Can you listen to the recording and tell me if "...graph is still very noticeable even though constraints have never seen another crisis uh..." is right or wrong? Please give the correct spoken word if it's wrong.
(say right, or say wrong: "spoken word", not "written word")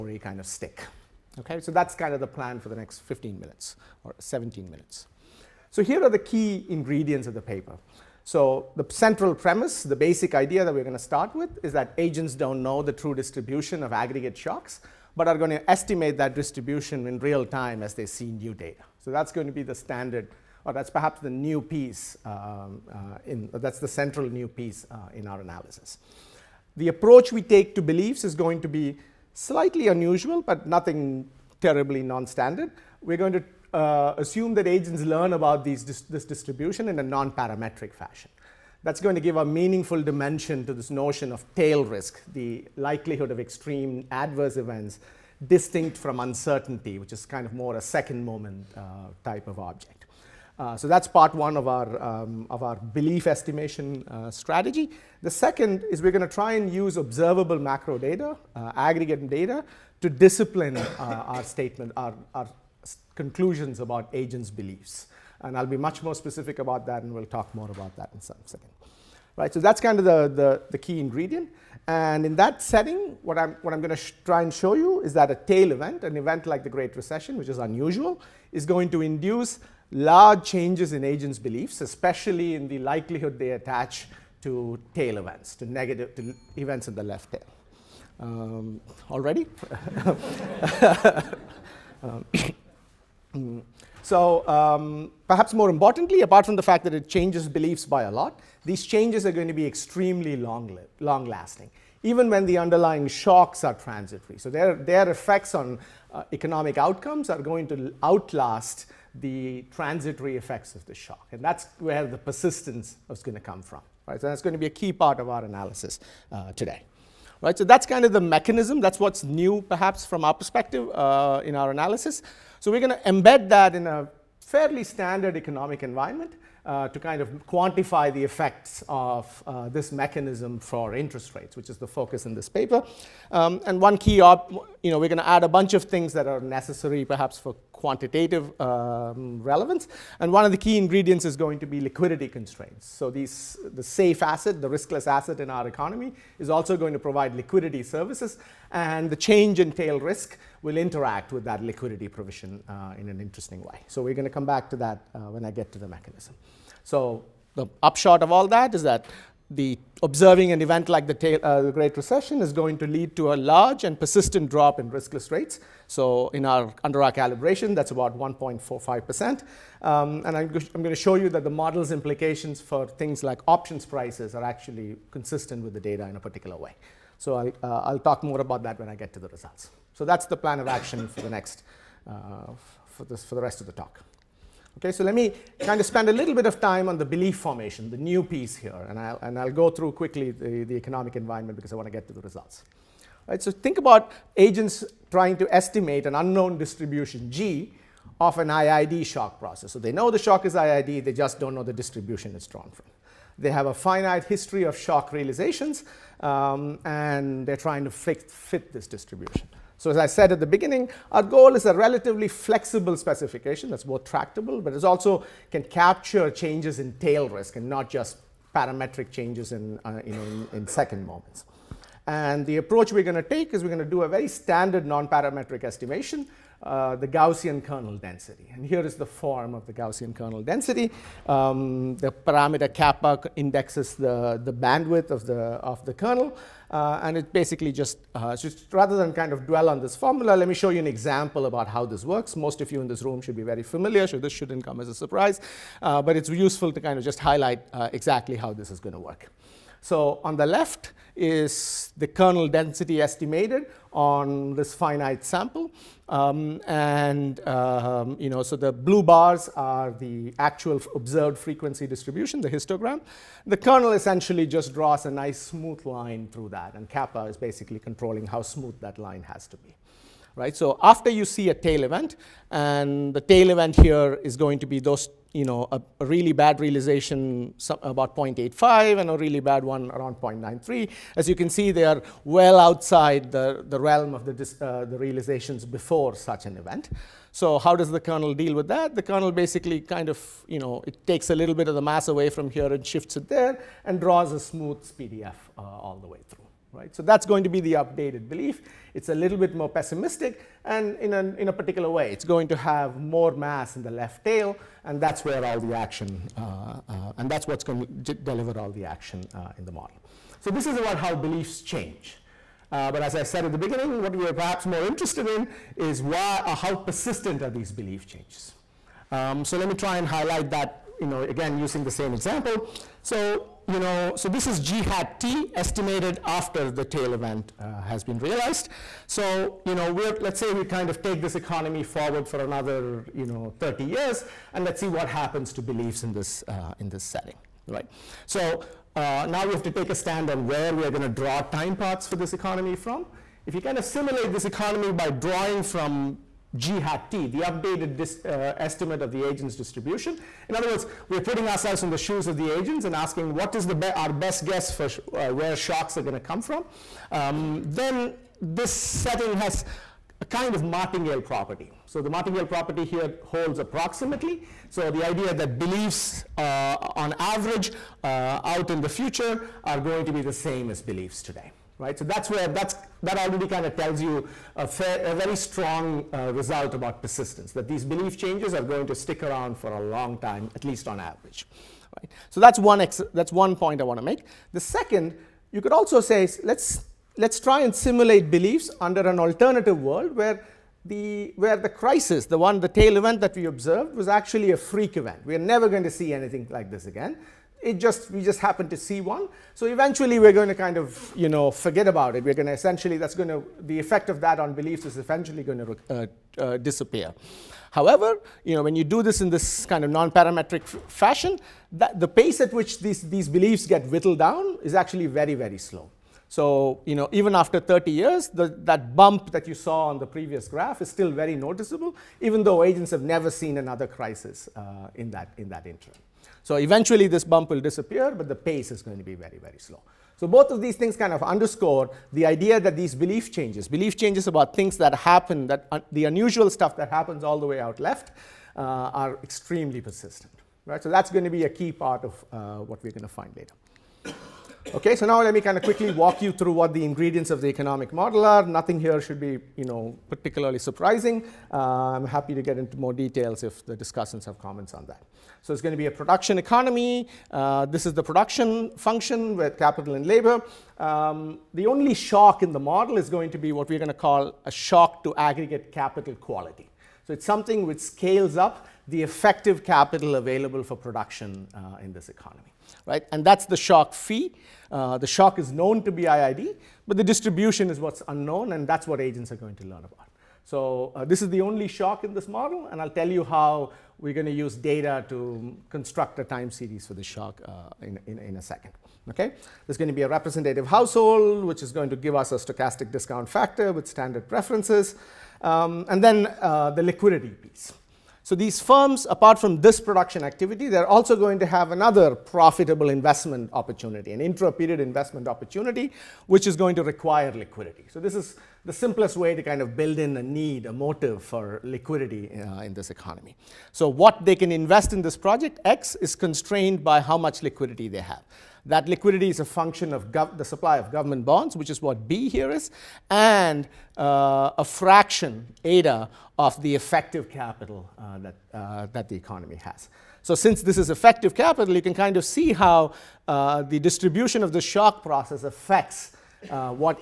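wrong: "agents", not "constraints".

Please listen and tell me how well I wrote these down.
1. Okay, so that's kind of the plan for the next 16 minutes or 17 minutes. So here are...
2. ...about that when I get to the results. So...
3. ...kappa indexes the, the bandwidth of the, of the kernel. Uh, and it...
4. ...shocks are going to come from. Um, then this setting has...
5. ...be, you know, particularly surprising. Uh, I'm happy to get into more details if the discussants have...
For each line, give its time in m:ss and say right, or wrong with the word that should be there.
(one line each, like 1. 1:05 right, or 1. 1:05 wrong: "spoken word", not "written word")
1. 0:01 wrong: "15", not "16"
2. 2:58 right
3. 3:52 right
4. 5:55 right
5. 7:29 right.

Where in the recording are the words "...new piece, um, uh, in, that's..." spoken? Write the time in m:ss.
0:21.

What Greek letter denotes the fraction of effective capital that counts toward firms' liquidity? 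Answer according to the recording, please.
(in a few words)
eta.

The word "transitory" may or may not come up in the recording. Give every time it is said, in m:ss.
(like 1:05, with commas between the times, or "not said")
1:43, 1:49.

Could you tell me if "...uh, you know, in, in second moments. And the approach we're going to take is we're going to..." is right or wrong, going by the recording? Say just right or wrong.
right.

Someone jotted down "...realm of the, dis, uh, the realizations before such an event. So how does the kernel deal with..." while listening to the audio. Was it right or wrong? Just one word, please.
right.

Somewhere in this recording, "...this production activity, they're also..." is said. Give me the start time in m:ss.
8:19.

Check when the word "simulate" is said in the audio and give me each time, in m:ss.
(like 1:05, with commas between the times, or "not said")
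5:43, 6:27.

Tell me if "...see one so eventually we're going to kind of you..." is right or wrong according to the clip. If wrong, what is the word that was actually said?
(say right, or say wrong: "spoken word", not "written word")
right.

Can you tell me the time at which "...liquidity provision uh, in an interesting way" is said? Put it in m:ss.
2:31.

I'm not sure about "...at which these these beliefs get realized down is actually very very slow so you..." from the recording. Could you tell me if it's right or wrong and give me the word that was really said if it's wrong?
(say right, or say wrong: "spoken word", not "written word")
wrong: "whittled", not "realized".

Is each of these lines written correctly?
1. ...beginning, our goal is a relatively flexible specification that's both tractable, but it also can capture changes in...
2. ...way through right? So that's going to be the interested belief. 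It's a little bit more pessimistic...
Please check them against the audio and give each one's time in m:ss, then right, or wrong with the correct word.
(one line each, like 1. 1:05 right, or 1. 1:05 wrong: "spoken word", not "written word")
1. 3:30 right
2. 4:56 wrong: "updated", not "interested".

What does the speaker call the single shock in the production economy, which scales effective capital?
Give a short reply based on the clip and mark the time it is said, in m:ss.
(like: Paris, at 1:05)
aggregate capital quality, at 7:45.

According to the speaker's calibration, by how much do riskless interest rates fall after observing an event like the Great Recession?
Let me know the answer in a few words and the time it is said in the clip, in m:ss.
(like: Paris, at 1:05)
1.45%, at 2:48.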